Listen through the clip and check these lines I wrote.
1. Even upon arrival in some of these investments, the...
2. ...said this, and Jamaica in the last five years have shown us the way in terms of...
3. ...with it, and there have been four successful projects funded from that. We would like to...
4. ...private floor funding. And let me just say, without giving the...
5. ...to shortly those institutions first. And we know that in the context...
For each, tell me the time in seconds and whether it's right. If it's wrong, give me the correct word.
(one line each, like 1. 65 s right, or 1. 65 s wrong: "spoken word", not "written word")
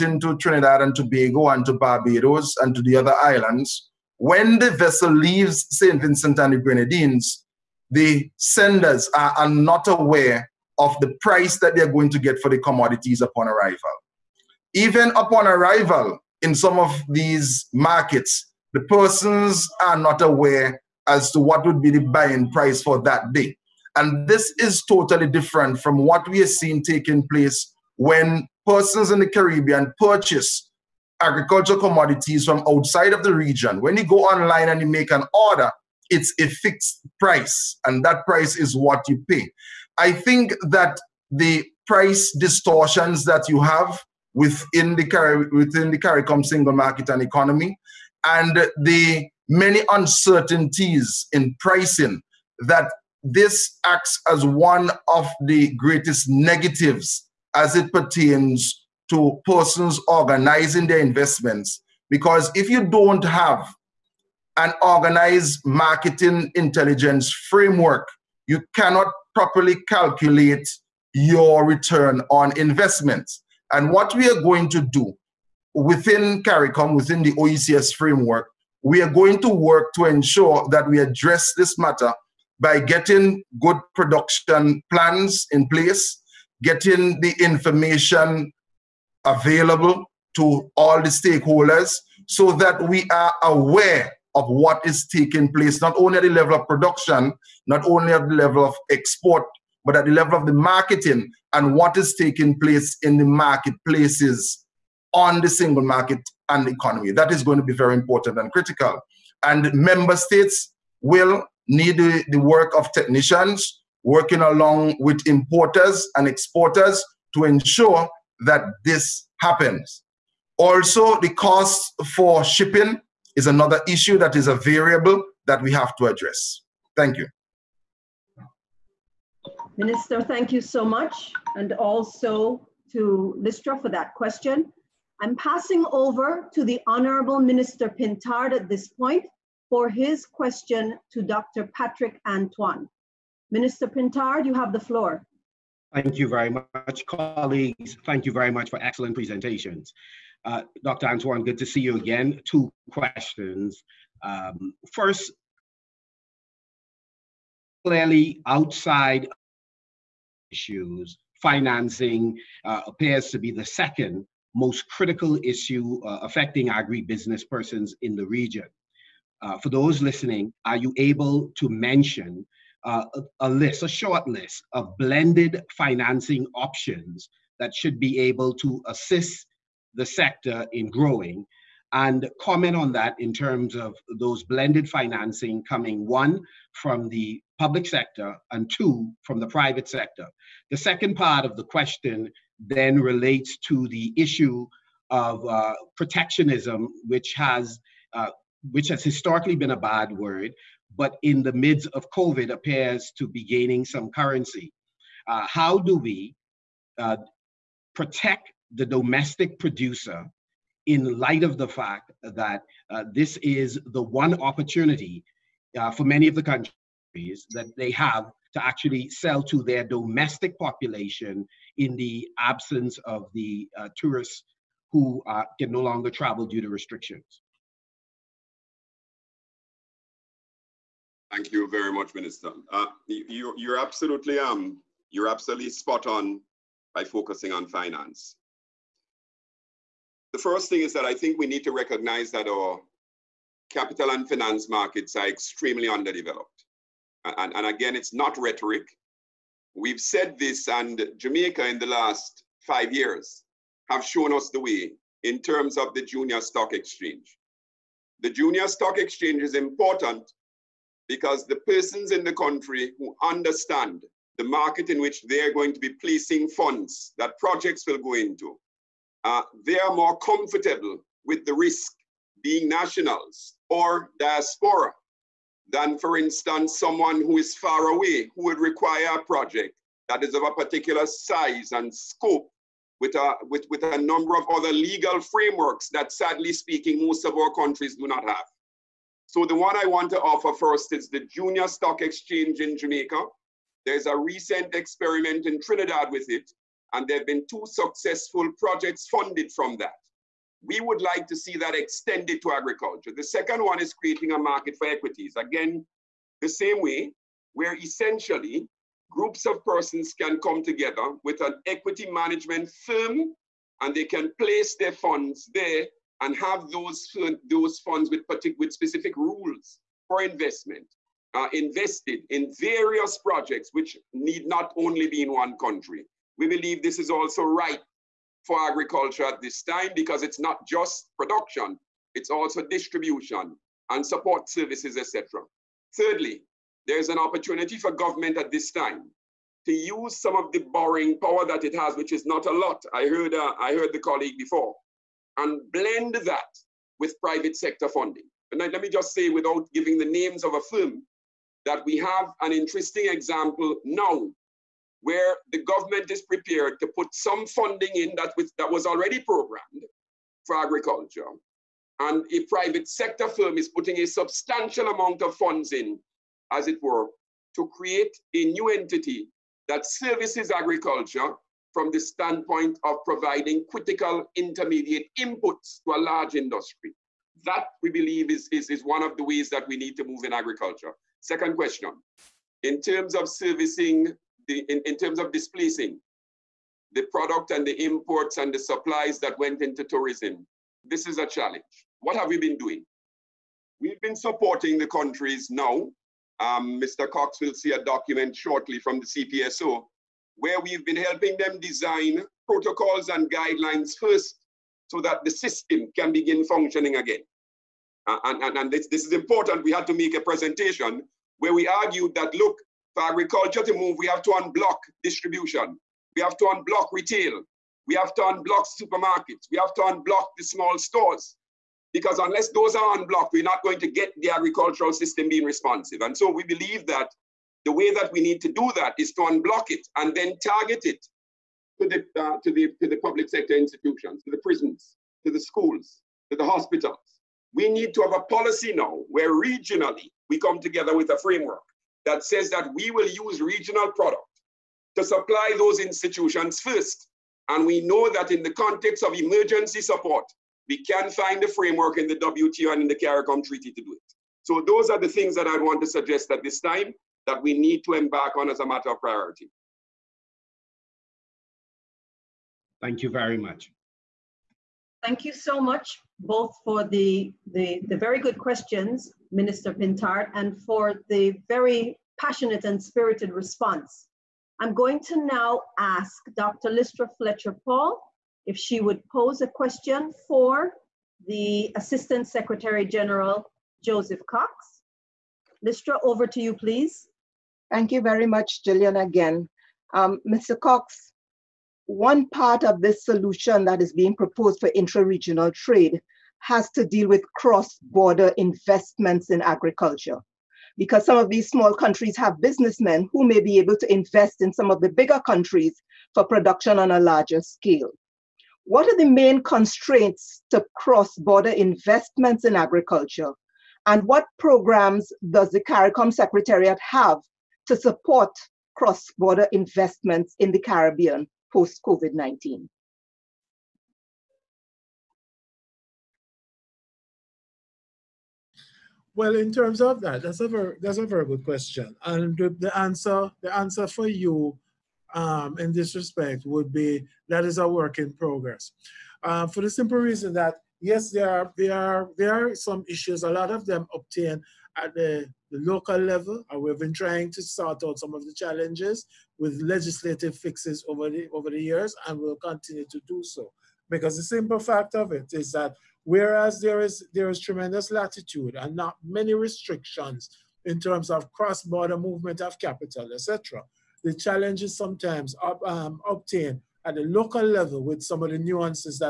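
1. 14 s wrong: "markets", not "investments"
2. 250 s right
3. 296 s wrong: "two", not "four"
4. 347 s wrong: "sector", not "floor"
5. 444 s wrong: "supply", not "shortly".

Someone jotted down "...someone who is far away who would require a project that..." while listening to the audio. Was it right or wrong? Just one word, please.
right.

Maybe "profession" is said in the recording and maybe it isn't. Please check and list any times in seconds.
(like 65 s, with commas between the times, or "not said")
not said.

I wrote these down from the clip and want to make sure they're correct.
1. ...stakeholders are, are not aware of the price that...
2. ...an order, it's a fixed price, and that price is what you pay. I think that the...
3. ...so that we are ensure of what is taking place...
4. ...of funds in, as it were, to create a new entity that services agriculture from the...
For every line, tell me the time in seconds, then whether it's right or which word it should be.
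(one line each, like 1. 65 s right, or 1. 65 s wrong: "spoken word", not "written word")
1. 8 s wrong: "senders", not "stakeholders"
2. 35 s right
3. 92 s wrong: "aware", not "ensure"
4. 365 s right.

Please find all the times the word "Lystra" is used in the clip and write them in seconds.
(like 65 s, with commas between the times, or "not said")
133 s, 476 s, 485 s.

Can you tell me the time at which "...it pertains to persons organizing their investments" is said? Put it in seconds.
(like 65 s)
57 s.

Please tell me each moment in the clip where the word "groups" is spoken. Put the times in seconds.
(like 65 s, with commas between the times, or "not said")
309 s.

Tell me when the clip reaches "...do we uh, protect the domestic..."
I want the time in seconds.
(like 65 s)
205 s.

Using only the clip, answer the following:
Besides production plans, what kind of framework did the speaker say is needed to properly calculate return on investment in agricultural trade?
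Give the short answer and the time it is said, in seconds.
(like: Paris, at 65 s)
marketing intelligence framework, at 65 s.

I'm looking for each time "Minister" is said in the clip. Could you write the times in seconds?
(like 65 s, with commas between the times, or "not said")
129 s, 137 s, 143 s, 232 s, 469 s.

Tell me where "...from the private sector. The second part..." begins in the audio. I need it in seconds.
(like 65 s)
189 s.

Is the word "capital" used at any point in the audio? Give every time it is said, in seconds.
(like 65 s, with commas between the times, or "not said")
243 s, 562 s.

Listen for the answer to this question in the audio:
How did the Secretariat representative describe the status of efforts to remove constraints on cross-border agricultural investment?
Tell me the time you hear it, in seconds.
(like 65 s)
537 s.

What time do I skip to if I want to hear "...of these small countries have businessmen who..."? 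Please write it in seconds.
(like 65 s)
501 s.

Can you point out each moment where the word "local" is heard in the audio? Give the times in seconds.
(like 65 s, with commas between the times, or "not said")
545 s, 567 s.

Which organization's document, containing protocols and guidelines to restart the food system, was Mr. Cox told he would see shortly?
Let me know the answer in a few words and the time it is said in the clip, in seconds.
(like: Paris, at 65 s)
CPSO, at 399 s.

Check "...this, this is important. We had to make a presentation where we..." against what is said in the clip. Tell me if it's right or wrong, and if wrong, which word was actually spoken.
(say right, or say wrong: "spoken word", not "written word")
right.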